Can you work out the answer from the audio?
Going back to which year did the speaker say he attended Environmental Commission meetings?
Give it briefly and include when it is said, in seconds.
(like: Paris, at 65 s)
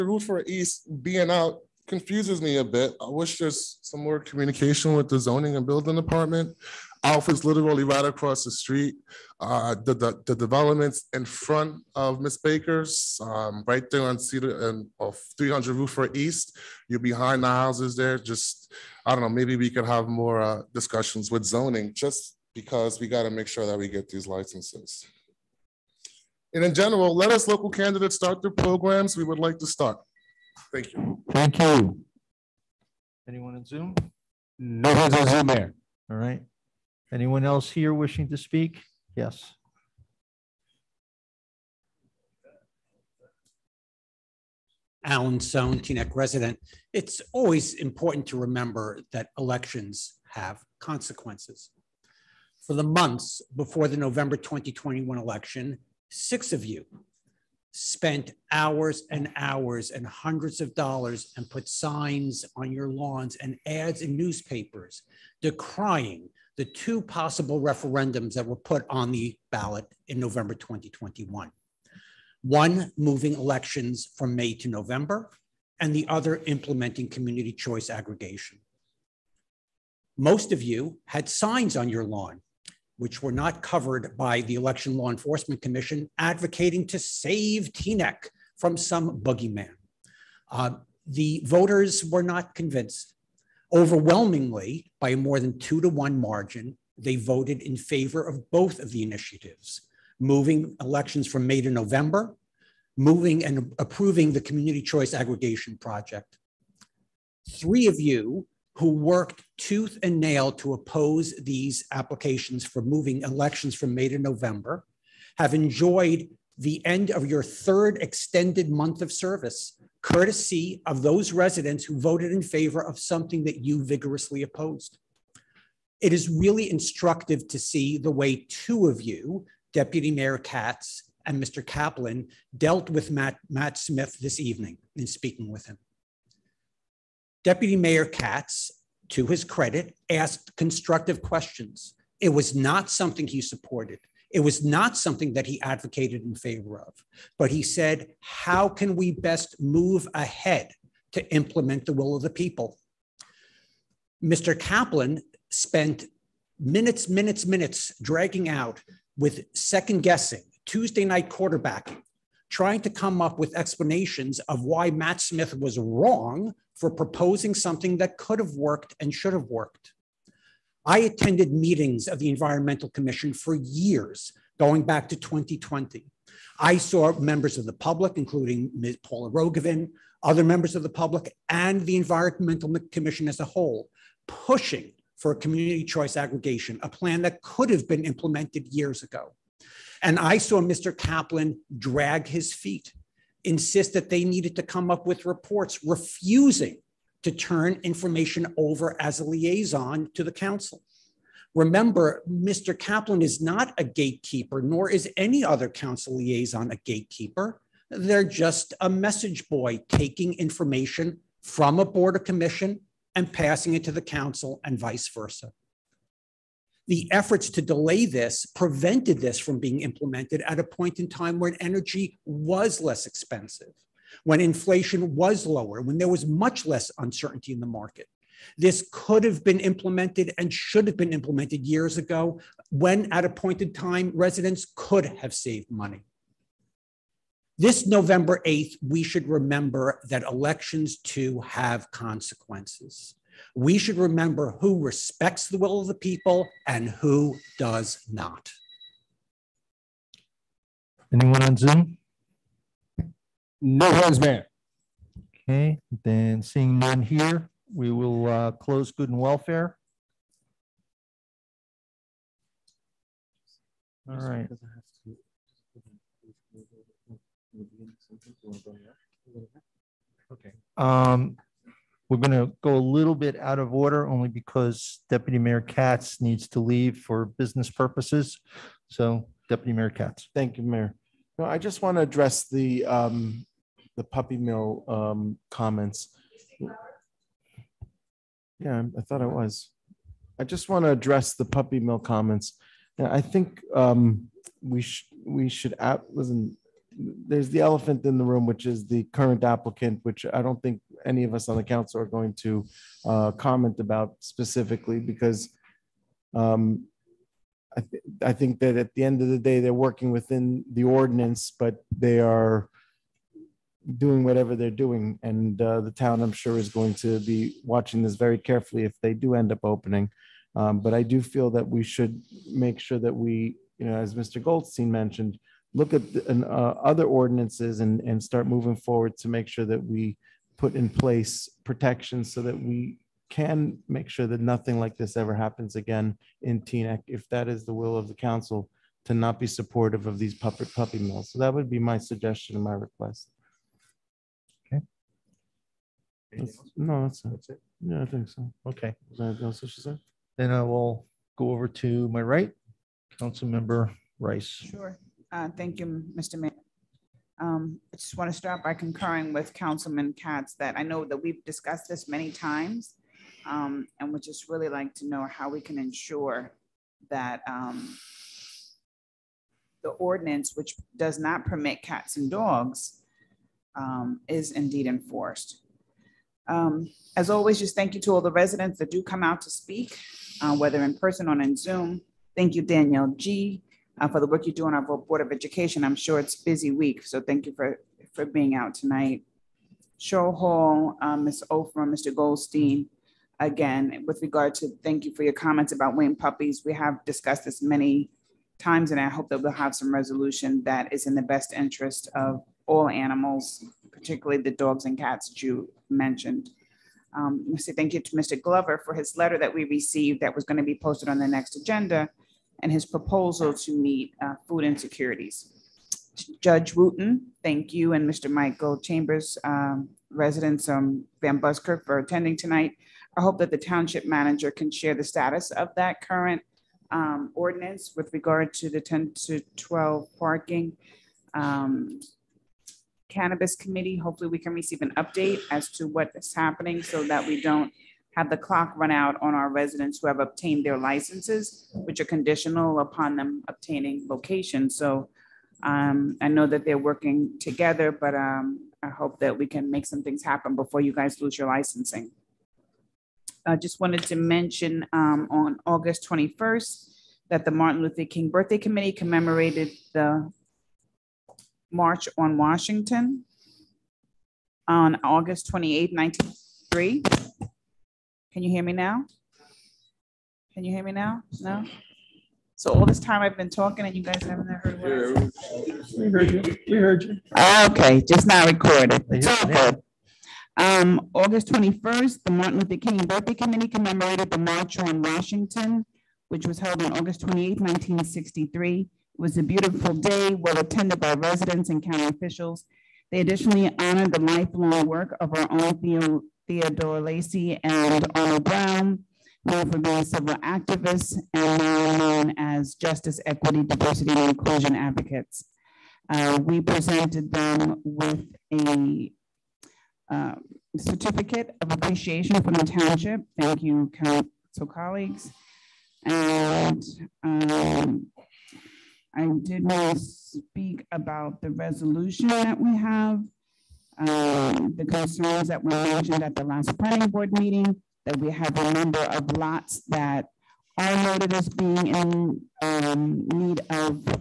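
2020, at 175 s.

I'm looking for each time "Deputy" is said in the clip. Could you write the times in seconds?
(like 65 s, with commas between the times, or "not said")
129 s, 137 s, 275 s, 279 s.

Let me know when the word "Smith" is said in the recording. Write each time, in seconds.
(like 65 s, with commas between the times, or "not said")
133 s, 165 s.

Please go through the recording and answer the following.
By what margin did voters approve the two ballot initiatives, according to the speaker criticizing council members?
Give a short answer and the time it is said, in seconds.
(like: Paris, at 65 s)
more than two to one, at 95 s.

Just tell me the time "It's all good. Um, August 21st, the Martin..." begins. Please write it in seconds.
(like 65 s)
479 s.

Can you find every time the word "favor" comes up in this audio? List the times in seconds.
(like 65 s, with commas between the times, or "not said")
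97 s, 122 s, 146 s.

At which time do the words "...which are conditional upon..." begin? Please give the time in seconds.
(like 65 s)
441 s.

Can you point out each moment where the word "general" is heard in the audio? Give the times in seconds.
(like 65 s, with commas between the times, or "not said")
26 s.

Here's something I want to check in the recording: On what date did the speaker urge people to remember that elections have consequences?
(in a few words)
November 8th.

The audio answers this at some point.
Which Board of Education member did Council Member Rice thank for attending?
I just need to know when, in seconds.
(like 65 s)
382 s.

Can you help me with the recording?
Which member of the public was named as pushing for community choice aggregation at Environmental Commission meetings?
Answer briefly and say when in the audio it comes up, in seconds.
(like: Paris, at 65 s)
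Paula Rogovin, at 178 s.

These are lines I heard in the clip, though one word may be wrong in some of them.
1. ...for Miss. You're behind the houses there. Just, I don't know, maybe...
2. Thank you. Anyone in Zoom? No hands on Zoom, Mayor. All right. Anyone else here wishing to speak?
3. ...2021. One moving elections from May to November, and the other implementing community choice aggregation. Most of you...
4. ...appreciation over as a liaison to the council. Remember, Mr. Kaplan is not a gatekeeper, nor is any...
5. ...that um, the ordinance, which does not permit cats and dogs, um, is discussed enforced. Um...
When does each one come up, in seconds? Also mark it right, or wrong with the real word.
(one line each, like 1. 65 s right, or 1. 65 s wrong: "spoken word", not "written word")
1. 15 s wrong: "East", not "Miss"
2. 31 s right
3. 70 s right
4. 197 s wrong: "information", not "appreciation"
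5. 367 s wrong: "indeed", not "discussed".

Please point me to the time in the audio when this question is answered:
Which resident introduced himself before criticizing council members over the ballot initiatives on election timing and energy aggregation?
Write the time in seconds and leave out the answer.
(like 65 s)
45 s.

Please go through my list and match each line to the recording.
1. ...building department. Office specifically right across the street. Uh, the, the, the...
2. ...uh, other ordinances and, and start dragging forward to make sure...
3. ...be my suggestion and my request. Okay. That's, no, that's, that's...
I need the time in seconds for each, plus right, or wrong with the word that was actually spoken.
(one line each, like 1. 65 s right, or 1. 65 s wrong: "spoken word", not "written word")
1. 5 s wrong: "literally", not "specifically"
2. 326 s wrong: "moving", not "dragging"
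3. 341 s right.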